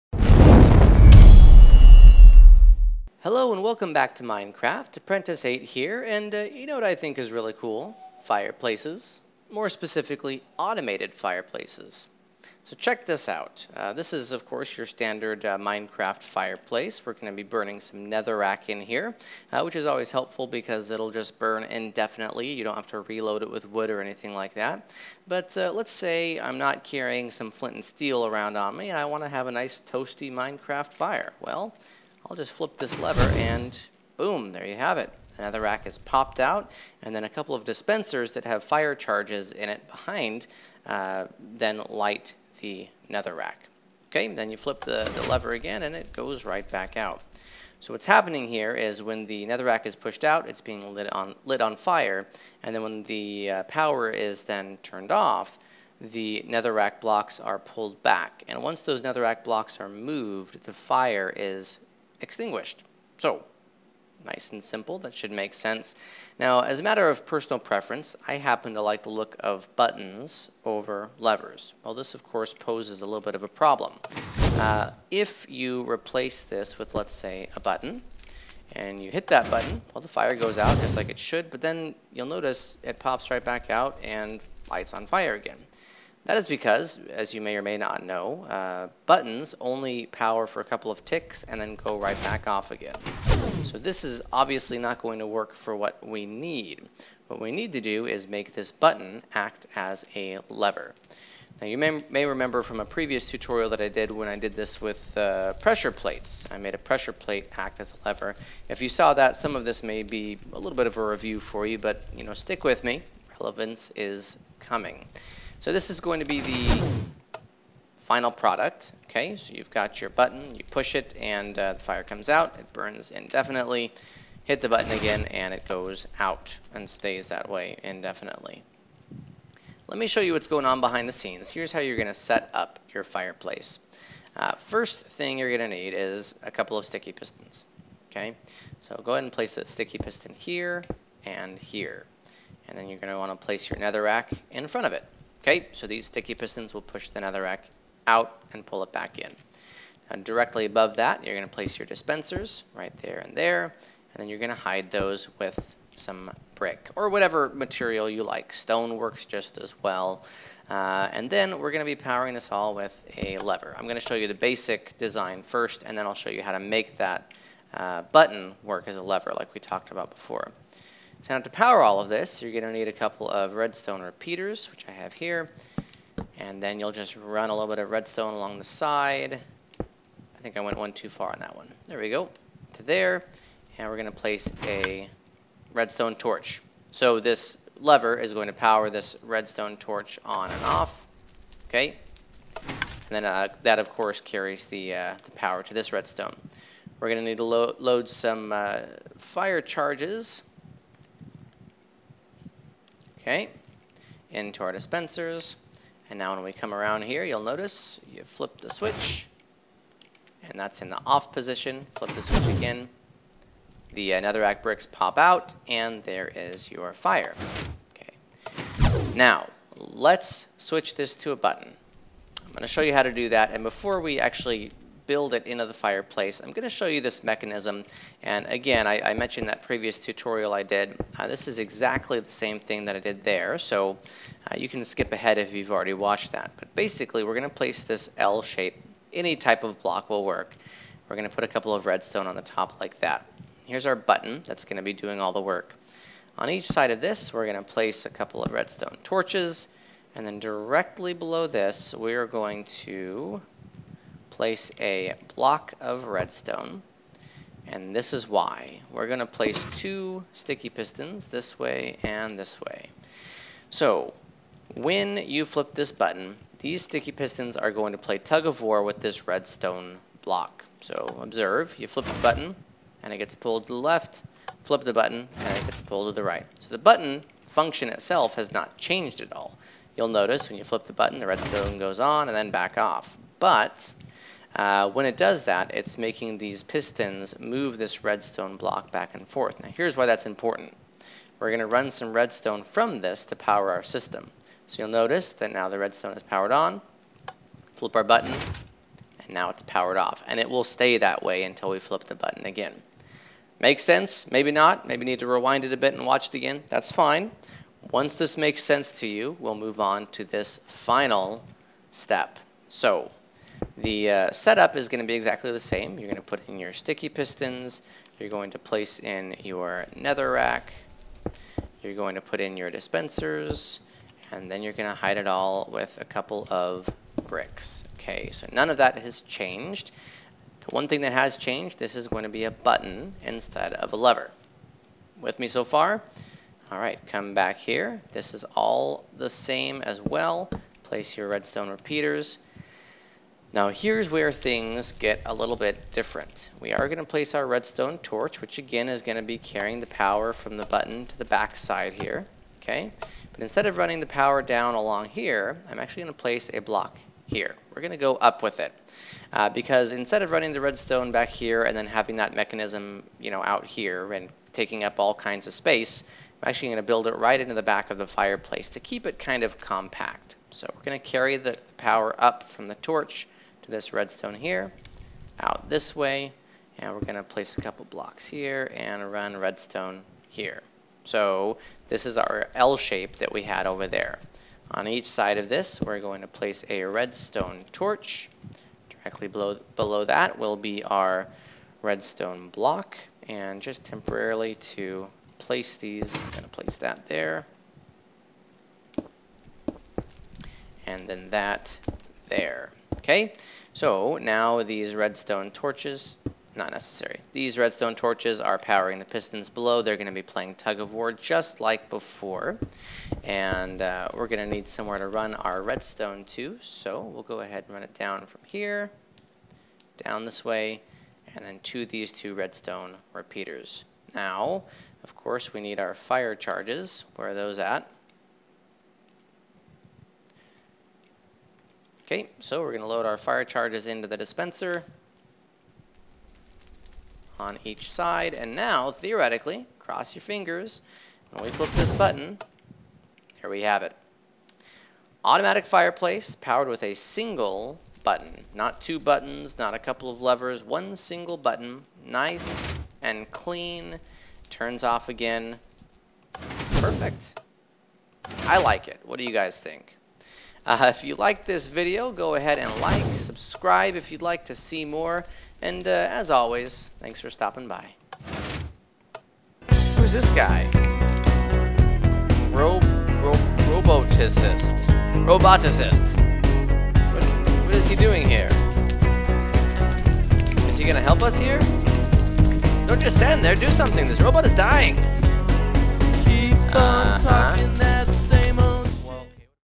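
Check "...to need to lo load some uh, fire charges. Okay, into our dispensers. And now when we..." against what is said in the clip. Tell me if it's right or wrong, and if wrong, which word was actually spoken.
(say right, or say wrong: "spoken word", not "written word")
right.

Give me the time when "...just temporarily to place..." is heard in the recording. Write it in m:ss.
6:33.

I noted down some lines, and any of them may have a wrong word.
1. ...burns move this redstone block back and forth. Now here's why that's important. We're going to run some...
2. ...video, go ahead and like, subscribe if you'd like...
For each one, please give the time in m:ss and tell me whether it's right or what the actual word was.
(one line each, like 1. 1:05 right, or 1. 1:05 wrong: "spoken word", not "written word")
1. 4:46 wrong: "pistons", not "burns"
2. 7:41 right.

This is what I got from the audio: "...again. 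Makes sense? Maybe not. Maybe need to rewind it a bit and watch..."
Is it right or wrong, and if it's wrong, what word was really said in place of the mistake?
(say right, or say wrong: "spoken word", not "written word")
right.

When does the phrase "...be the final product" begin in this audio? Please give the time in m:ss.
1:56.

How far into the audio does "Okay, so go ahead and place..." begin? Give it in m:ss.
2:18.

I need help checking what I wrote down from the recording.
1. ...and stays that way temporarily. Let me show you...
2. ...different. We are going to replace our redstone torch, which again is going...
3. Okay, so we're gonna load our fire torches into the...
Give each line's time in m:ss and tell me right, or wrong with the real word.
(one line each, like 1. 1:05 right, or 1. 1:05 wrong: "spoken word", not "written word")
1. 2:06 wrong: "indefinitely", not "temporarily"
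2. 5:45 wrong: "place", not "replace"
3. 7:12 wrong: "charges", not "torches".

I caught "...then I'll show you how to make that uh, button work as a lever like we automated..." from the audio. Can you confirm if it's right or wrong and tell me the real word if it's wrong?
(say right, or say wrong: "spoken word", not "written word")
wrong: "talked", not "automated".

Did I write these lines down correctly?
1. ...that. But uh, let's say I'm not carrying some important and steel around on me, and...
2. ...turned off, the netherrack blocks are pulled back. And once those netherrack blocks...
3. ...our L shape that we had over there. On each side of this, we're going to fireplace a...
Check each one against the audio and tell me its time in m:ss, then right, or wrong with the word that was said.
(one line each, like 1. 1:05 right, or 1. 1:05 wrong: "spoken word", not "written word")
1. 0:24 wrong: "flint", not "important"
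2. 0:54 right
3. 6:22 wrong: "place", not "fireplace".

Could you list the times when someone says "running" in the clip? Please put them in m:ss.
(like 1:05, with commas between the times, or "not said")
5:53, 6:00.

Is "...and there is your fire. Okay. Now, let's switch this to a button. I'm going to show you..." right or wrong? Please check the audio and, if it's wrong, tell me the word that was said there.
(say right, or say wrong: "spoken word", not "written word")
right.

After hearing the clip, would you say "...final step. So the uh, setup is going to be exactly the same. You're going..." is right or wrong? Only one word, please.
right.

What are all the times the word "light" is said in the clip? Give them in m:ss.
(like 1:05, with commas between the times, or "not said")
0:41, 1:24.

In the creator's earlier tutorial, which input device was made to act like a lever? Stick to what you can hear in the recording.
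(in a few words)
Pressure plates.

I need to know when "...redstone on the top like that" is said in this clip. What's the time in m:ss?
4:01.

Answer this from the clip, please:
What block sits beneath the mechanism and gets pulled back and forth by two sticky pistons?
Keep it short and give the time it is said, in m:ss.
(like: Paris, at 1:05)
Block of redstone, at 4:15.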